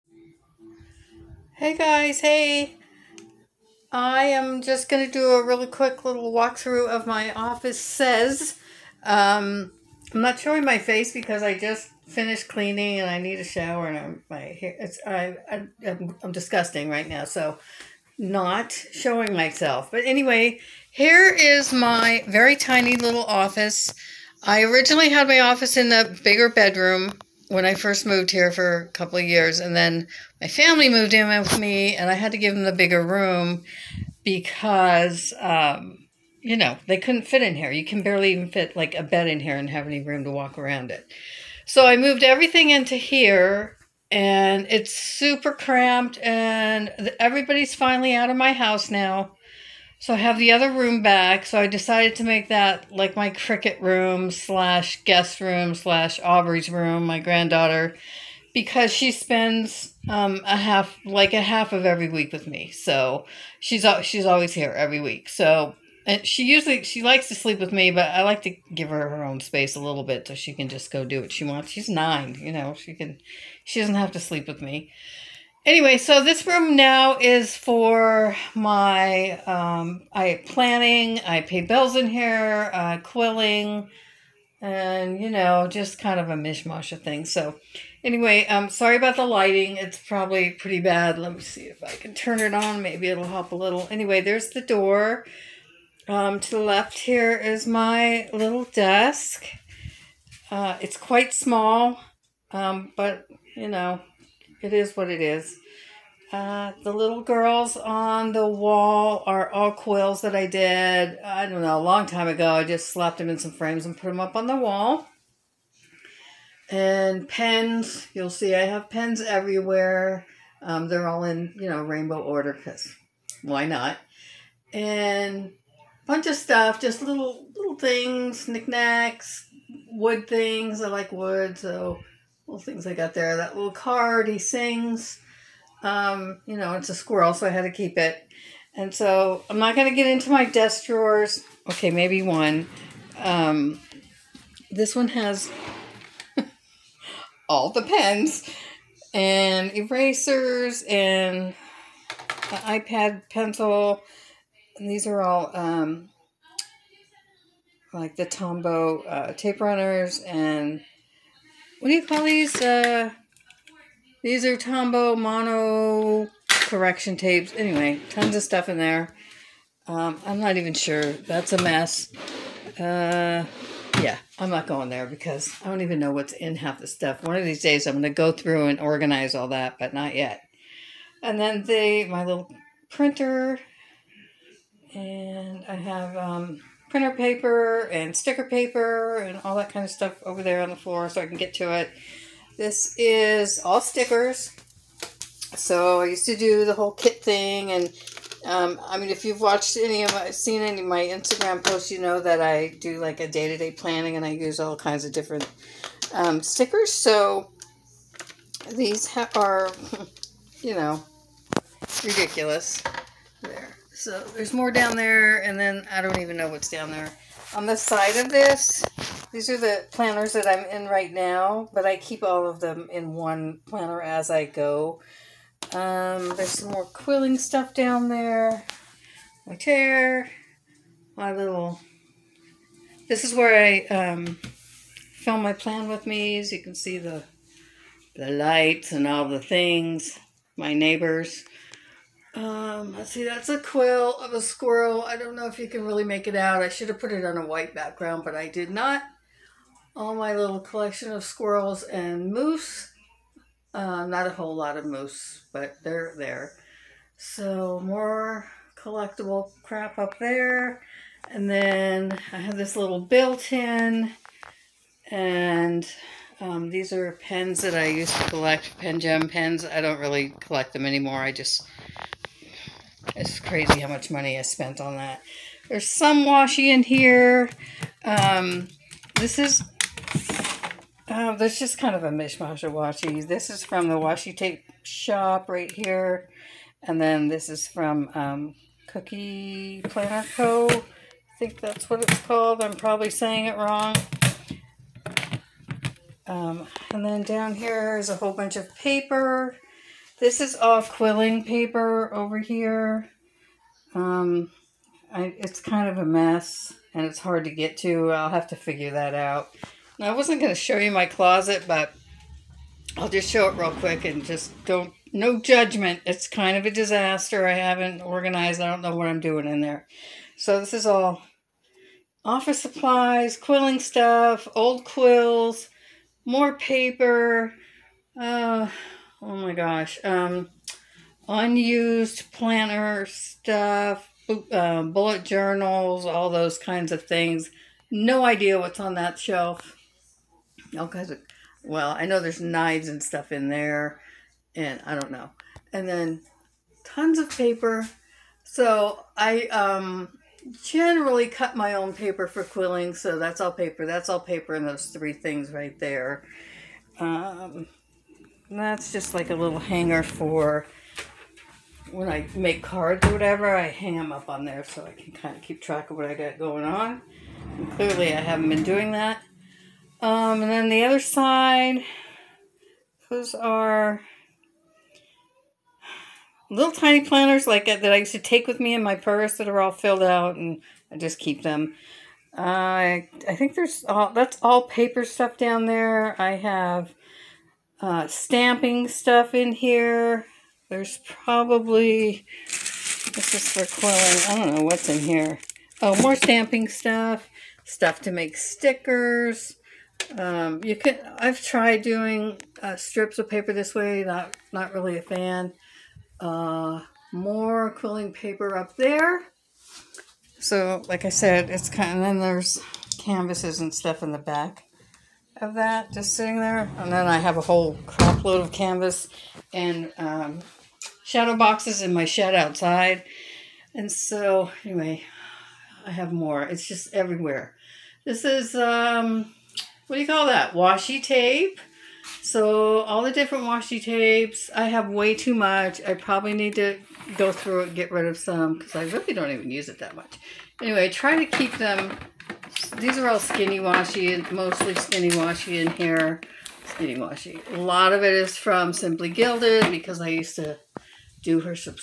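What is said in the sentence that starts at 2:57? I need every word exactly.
One of these days, I'm going to go through and organize all that, but not yet.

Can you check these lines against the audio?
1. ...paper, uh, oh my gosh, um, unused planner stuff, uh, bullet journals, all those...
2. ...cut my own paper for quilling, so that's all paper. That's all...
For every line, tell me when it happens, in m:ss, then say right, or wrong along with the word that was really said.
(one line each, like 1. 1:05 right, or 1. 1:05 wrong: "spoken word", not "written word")
1. 5:26 right
2. 5:51 right.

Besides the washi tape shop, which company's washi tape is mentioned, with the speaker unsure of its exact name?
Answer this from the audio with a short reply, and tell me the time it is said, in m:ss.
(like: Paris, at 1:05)
Cookie Planner Co, at 4:48.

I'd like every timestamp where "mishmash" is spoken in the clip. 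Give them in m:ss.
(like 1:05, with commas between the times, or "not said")
1:26, 4:42.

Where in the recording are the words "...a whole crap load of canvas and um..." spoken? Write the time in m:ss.
6:57.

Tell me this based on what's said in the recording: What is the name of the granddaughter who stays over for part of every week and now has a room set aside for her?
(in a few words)
Aubrey.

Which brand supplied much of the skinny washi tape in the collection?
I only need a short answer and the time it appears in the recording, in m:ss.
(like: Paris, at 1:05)
Simply Gilded, at 7:28.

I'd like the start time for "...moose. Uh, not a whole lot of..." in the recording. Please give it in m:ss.
4:12.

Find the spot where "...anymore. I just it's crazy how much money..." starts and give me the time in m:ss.
4:30.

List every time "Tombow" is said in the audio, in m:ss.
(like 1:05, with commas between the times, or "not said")
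2:38, 2:44.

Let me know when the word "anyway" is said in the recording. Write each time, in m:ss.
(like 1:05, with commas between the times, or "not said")
0:20, 1:15, 1:28, 1:33, 2:47, 7:04, 7:20.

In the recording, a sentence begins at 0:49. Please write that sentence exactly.
So I have the other room back.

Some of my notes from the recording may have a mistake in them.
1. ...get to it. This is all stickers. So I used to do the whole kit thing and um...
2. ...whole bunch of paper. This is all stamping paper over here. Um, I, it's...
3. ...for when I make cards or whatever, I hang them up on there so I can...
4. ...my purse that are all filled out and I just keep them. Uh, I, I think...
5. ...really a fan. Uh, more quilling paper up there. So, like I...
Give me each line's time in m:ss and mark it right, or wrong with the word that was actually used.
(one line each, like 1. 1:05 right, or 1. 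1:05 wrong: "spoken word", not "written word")
1. 3:11 right
2. 4:58 wrong: "quilling", not "stamping"
3. 6:00 right
4. 6:18 right
5. 6:44 right.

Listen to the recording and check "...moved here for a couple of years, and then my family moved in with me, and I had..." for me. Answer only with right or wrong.
right.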